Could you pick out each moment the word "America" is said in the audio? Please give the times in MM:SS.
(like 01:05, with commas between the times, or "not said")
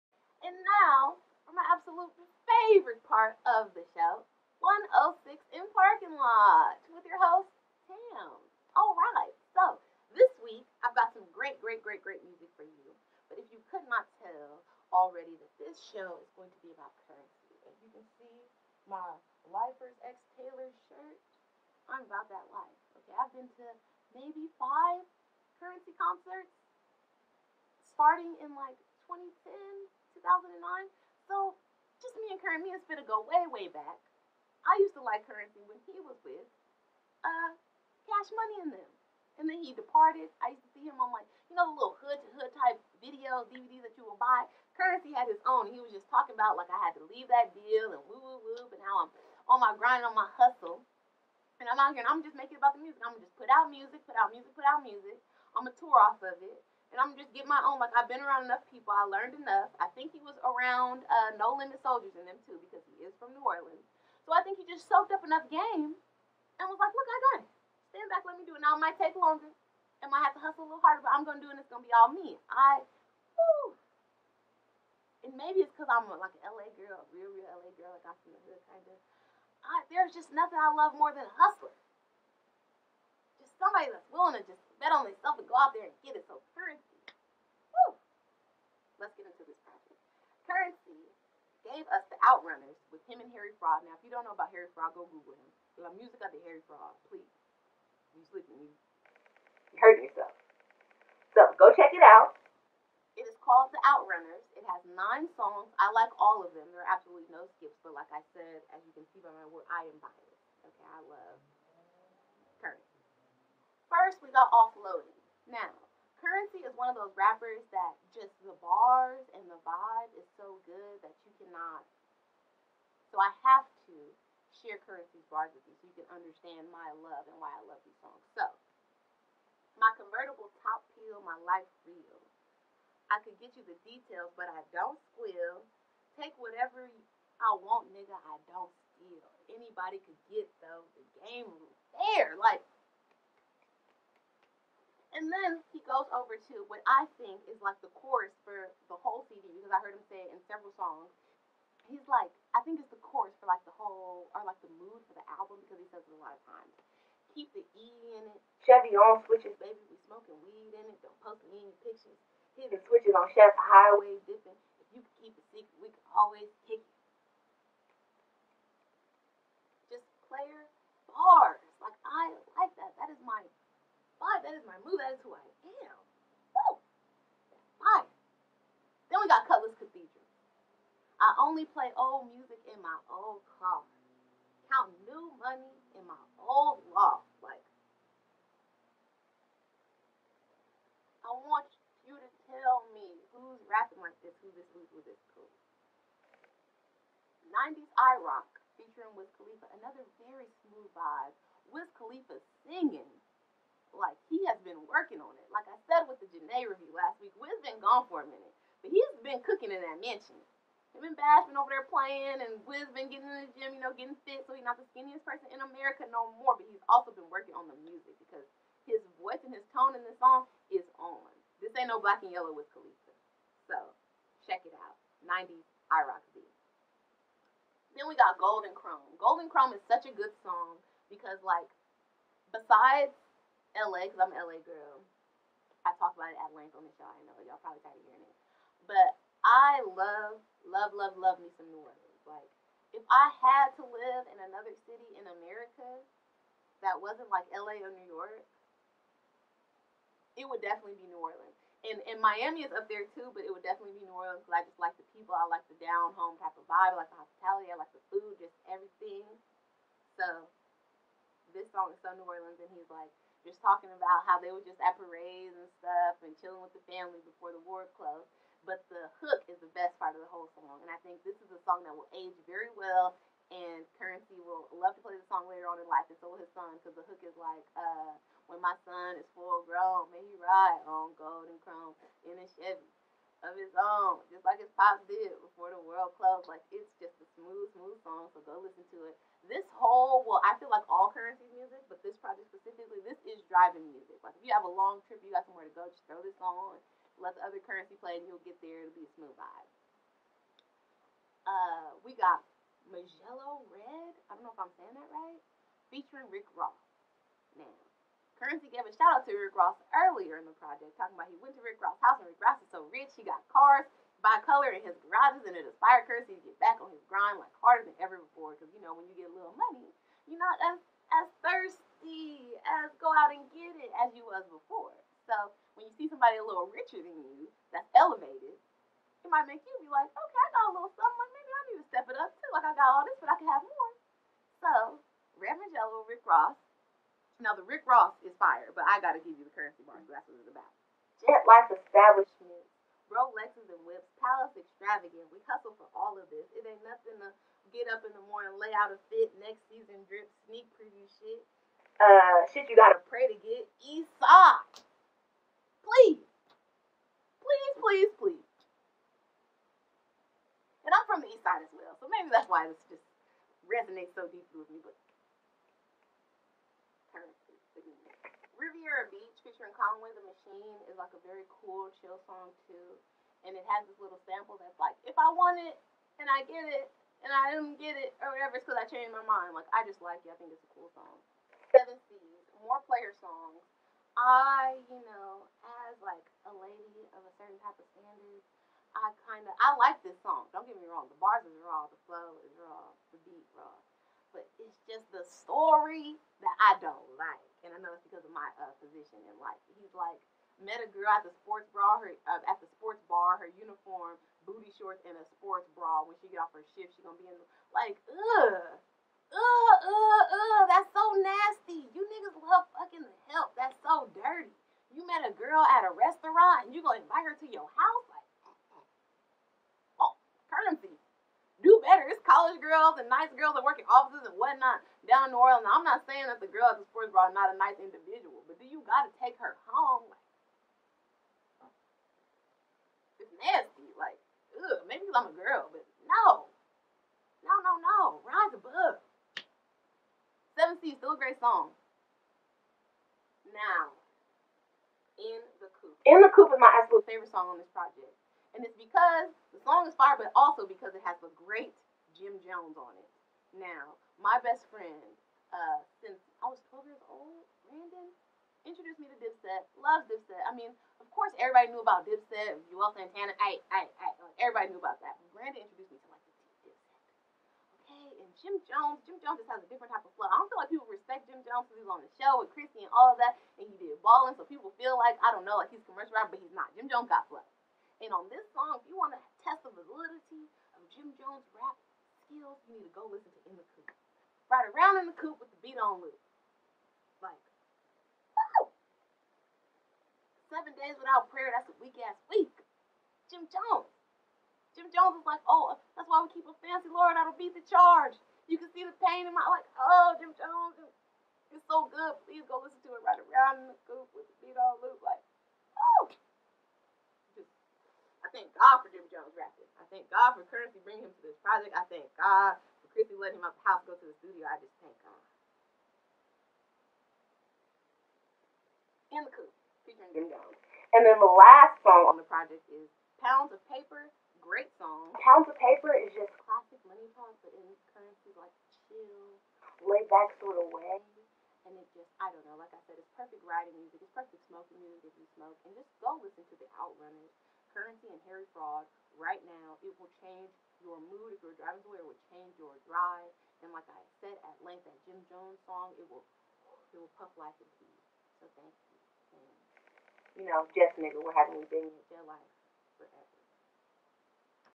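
03:35, 04:05.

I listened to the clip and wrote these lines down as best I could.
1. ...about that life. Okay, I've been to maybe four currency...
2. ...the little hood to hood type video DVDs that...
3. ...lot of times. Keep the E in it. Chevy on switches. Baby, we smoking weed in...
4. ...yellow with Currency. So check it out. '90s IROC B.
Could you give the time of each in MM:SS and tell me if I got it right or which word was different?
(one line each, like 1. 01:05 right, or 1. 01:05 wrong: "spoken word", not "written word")
1. 00:22 wrong: "five", not "four"
2. 00:41 right
3. 02:36 right
4. 03:42 wrong: "Khalifa", not "Currency".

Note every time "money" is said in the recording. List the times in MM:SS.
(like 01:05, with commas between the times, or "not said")
00:38, 03:05, 05:19, 08:46.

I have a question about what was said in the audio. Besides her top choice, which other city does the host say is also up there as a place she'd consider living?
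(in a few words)
Miami.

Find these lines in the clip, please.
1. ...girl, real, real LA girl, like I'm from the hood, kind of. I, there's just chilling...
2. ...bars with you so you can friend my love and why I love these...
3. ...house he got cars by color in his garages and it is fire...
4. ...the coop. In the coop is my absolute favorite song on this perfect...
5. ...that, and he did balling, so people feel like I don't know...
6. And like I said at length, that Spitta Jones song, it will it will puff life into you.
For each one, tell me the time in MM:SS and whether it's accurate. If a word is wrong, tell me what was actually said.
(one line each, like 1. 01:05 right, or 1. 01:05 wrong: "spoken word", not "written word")
1. 01:16 wrong: "nothing", not "chilling"
2. 02:05 wrong: "understand", not "friend"
3. 05:12 right
4. 07:25 wrong: "project", not "perfect"
5. 07:53 right
6. 09:03 wrong: "Jim", not "Spitta".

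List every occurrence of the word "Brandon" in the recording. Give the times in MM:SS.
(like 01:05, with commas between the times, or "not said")
07:37, 07:45.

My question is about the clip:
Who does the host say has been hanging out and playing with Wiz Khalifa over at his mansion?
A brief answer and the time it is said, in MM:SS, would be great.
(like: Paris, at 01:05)
Bash, at 03:31.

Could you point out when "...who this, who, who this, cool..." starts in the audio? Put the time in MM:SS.
03:14.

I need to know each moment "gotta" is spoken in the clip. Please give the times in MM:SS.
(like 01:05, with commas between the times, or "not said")
05:38, 05:52, 07:08.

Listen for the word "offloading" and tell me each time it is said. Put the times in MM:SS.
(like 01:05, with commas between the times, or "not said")
01:54.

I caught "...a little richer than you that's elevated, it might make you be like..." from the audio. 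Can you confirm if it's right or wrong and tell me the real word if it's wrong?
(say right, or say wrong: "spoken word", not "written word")
right.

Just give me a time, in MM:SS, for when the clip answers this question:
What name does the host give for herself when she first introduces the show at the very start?
00:07.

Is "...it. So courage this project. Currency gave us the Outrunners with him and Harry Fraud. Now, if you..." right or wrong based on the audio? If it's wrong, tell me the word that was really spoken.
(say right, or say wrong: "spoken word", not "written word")
right.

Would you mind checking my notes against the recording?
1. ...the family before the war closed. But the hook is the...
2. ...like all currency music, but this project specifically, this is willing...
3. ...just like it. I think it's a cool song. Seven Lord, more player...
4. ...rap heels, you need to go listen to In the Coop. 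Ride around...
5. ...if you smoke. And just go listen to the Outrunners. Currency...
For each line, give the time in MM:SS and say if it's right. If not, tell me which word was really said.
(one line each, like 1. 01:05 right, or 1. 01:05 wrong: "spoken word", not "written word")
1. 04:26 right
2. 04:50 wrong: "driving", not "willing"
3. 06:19 wrong: "Seas", not "Lord"
4. 08:01 right
5. 08:55 right.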